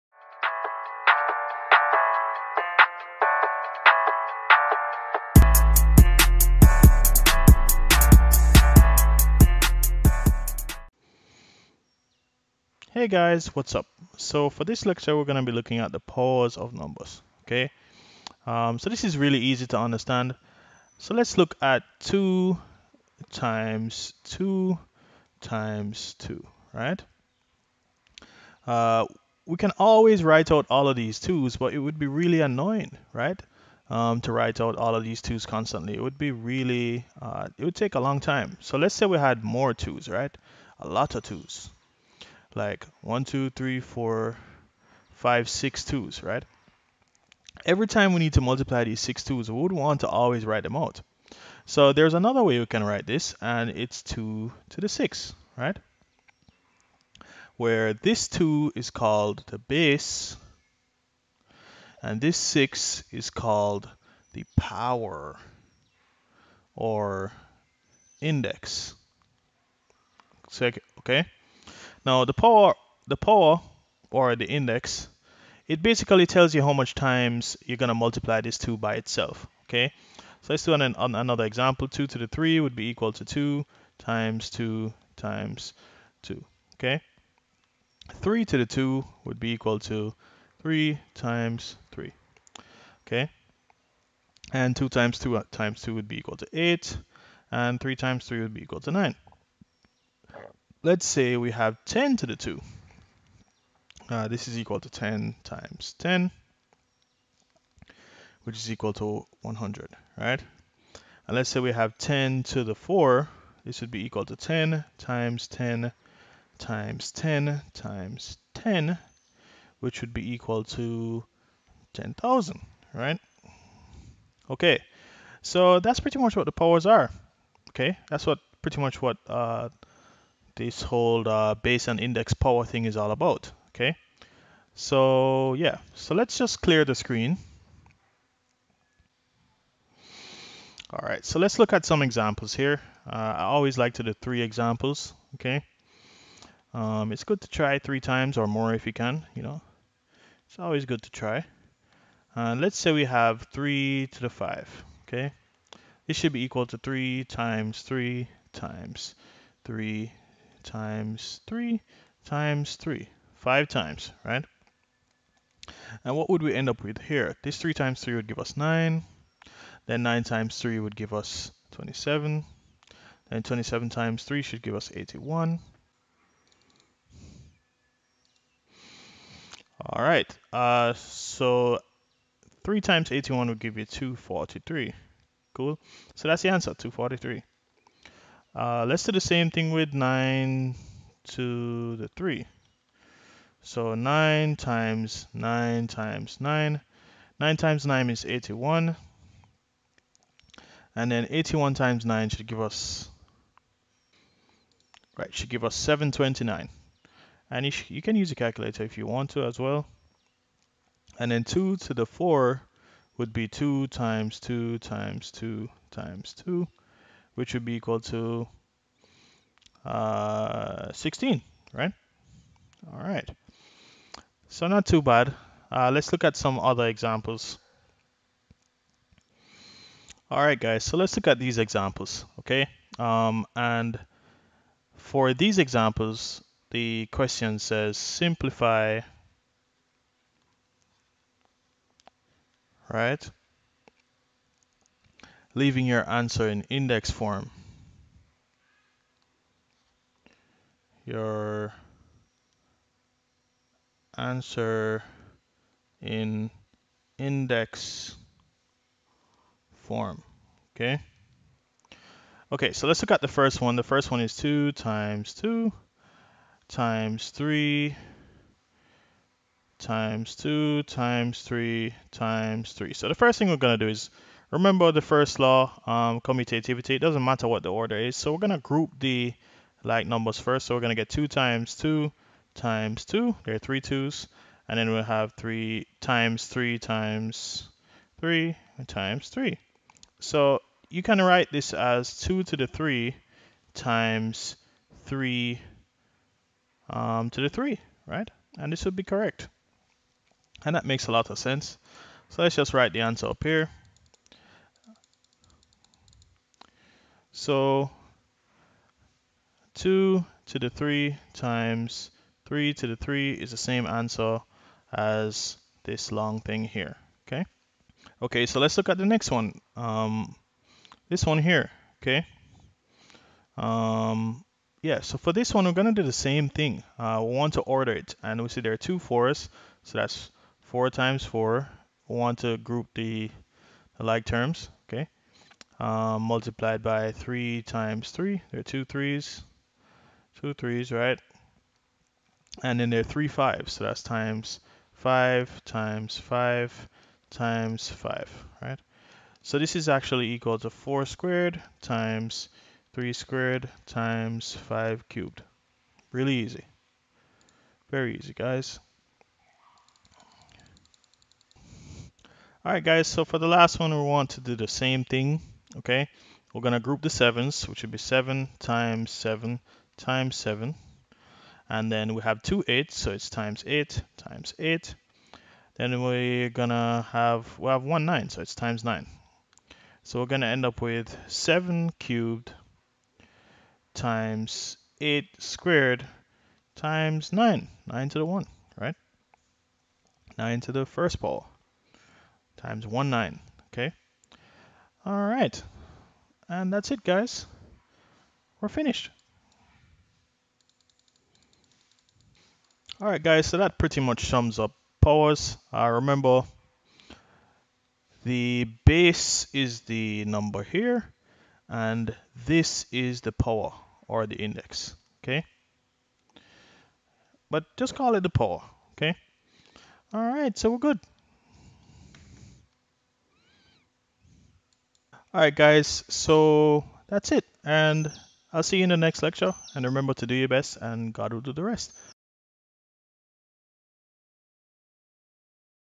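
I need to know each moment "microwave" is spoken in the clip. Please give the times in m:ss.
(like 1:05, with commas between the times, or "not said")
not said.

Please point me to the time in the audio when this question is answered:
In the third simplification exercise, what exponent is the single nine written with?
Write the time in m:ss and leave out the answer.
6:27.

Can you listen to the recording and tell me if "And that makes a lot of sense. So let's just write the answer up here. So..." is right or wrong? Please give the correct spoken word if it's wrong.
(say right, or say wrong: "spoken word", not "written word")
right.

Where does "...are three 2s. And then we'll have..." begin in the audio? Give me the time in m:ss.
4:43.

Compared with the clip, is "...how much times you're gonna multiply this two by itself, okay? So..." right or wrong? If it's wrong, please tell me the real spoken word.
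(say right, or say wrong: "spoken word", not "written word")
right.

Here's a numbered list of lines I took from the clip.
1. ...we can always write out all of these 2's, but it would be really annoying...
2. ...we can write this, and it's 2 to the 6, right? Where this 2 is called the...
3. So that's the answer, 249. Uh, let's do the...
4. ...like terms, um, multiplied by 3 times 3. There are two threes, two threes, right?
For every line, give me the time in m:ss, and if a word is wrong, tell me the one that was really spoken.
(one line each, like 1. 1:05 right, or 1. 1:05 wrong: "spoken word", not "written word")
1. 0:29 right
2. 0:52 right
3. 3:06 wrong: "243", not "249"
4. 5:34 right.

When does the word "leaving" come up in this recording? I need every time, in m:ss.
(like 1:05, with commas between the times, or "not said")
4:05.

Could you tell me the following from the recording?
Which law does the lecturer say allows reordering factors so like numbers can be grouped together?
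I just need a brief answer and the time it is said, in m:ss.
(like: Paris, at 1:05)
commutativity, at 4:36.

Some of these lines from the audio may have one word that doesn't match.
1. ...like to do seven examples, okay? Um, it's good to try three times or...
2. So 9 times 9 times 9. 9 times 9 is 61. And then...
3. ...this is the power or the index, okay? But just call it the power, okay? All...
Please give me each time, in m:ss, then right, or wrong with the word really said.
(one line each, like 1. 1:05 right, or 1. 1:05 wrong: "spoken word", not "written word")
1. 2:23 wrong: "three", not "seven"
2. 3:13 wrong: "81", not "61"
3. 6:52 right.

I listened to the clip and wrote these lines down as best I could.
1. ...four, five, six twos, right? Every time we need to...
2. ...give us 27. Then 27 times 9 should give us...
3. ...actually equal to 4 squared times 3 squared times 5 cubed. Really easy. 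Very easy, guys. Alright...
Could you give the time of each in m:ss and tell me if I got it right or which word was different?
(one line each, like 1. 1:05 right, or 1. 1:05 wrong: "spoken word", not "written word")
1. 0:43 right
2. 2:50 wrong: "3", not "9"
3. 5:49 right.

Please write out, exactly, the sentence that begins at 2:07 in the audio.
Okay, that's what pretty much what uh, this whole uh, base and index power thing is all about, okay?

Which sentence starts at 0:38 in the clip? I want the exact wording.
So let's say we had more 2's, right?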